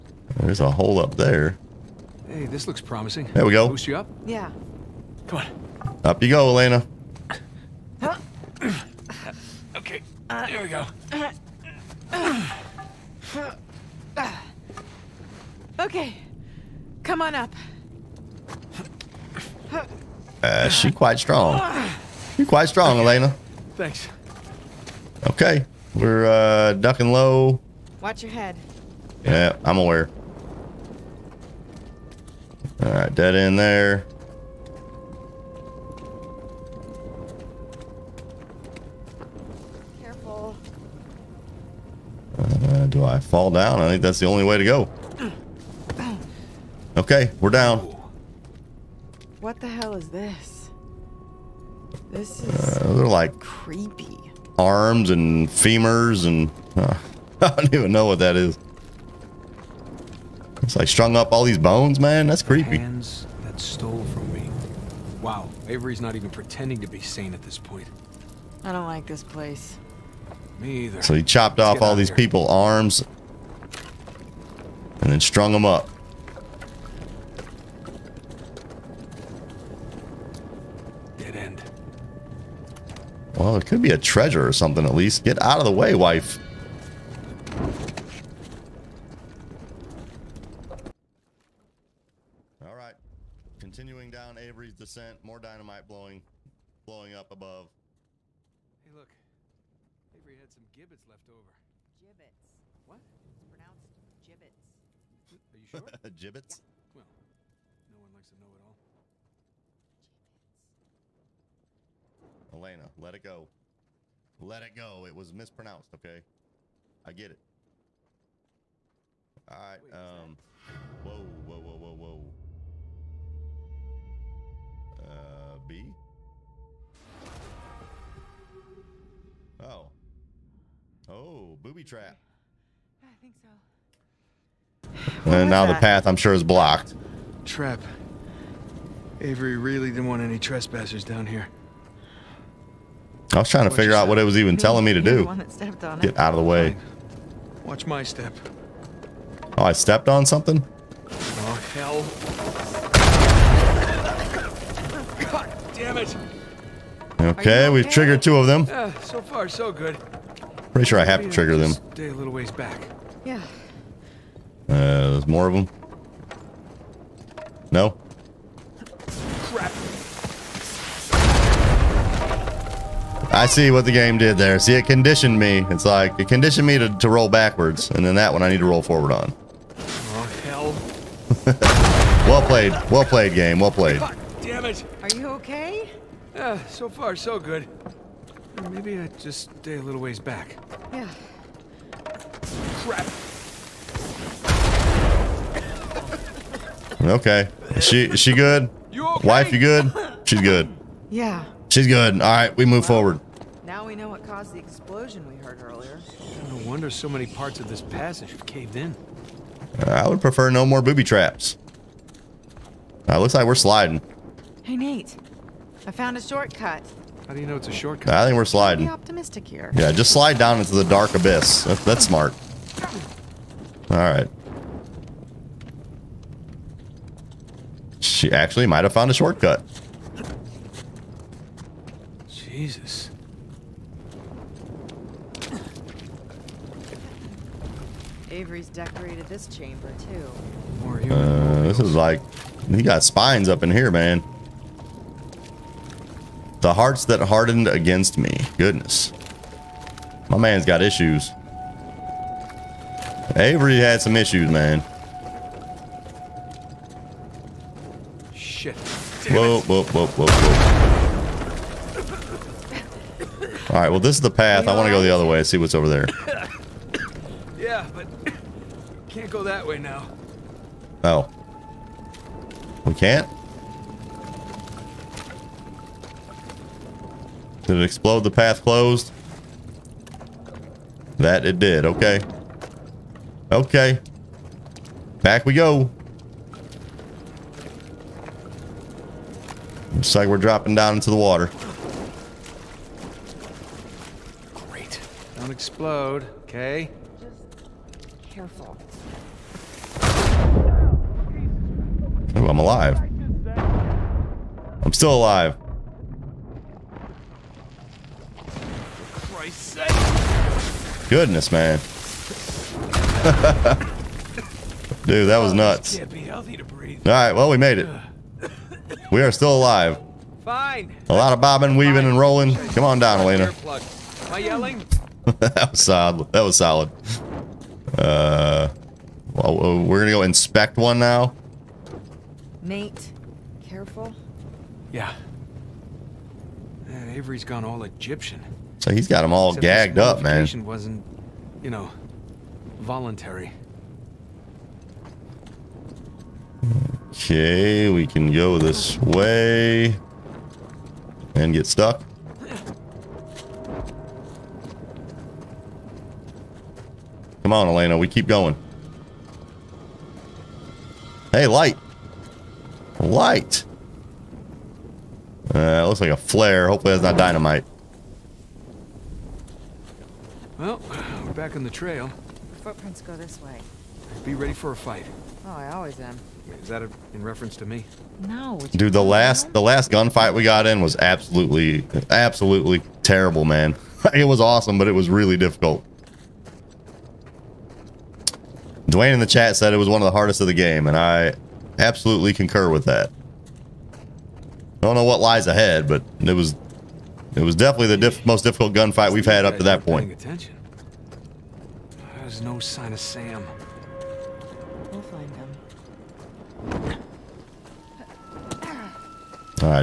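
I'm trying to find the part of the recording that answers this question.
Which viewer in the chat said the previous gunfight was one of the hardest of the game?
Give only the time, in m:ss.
6:28.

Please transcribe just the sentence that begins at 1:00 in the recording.
It's like strung up all these bones, man.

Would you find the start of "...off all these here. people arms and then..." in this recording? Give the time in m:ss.
1:11.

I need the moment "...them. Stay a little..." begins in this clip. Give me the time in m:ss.
2:41.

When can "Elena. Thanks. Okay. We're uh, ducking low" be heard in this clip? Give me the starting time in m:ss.
0:23.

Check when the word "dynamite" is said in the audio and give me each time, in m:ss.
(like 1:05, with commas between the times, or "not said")
1:35, 6:07.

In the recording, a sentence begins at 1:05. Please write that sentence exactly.
Wow, Avery's not even pretending to be sane at this point.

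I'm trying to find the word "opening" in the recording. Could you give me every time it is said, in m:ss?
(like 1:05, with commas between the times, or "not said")
not said.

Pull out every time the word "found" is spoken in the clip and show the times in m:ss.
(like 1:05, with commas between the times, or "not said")
3:35, 3:48.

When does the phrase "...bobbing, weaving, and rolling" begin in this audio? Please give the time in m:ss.
5:21.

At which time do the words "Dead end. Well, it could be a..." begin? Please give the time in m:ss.
1:21.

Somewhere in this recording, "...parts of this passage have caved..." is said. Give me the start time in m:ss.
3:27.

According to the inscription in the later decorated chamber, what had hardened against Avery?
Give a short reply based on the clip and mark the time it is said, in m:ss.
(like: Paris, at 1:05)
The hearts, at 4:06.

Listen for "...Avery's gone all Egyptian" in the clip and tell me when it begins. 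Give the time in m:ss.
5:37.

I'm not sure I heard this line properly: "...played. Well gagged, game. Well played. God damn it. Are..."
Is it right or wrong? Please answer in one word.
wrong.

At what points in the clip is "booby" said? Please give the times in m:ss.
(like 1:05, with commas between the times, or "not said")
2:11, 3:30.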